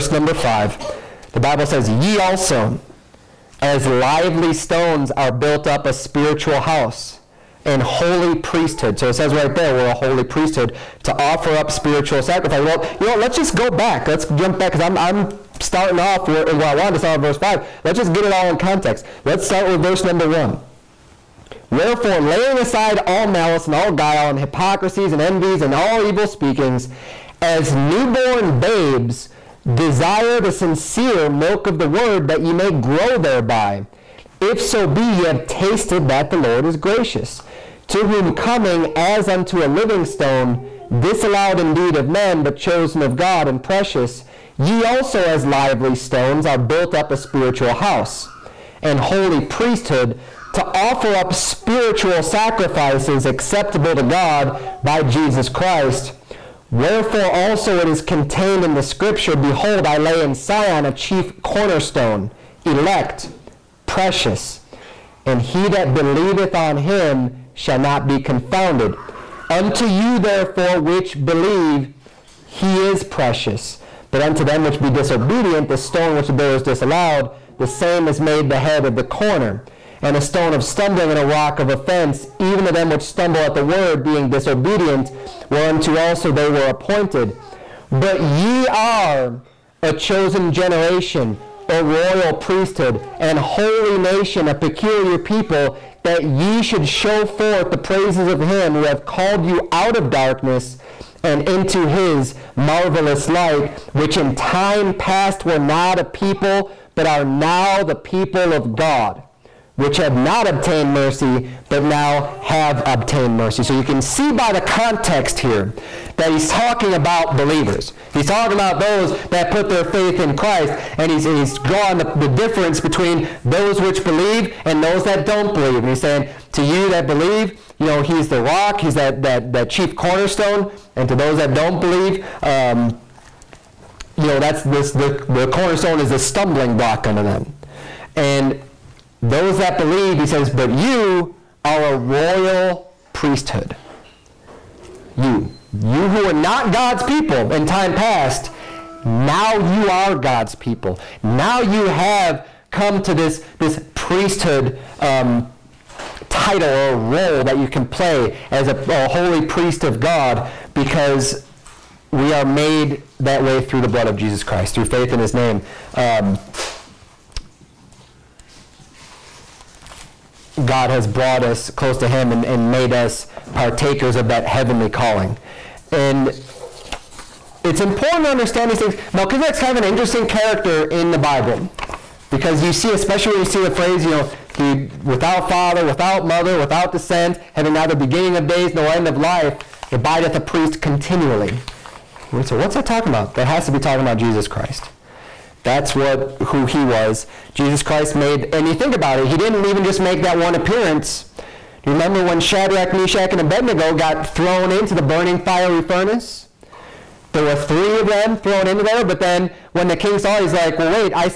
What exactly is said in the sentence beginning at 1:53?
So you can see by the context here that he's talking about believers.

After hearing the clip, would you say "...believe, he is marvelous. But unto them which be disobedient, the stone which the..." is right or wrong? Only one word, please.
wrong.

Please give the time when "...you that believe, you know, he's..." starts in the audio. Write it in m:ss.
2:06.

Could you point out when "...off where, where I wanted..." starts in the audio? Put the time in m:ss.
0:15.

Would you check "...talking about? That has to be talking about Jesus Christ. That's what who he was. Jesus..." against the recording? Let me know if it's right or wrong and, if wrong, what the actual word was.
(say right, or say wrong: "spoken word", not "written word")
right.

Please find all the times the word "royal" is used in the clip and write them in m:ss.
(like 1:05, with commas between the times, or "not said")
1:31, 2:21.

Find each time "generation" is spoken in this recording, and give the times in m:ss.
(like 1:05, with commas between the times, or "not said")
1:30.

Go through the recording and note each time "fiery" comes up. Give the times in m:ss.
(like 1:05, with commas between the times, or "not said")
3:25.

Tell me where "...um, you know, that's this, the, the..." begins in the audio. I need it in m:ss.
2:12.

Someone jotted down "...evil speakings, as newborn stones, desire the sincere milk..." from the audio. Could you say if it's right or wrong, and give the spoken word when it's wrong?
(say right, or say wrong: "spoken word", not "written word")
wrong: "babes", not "stones".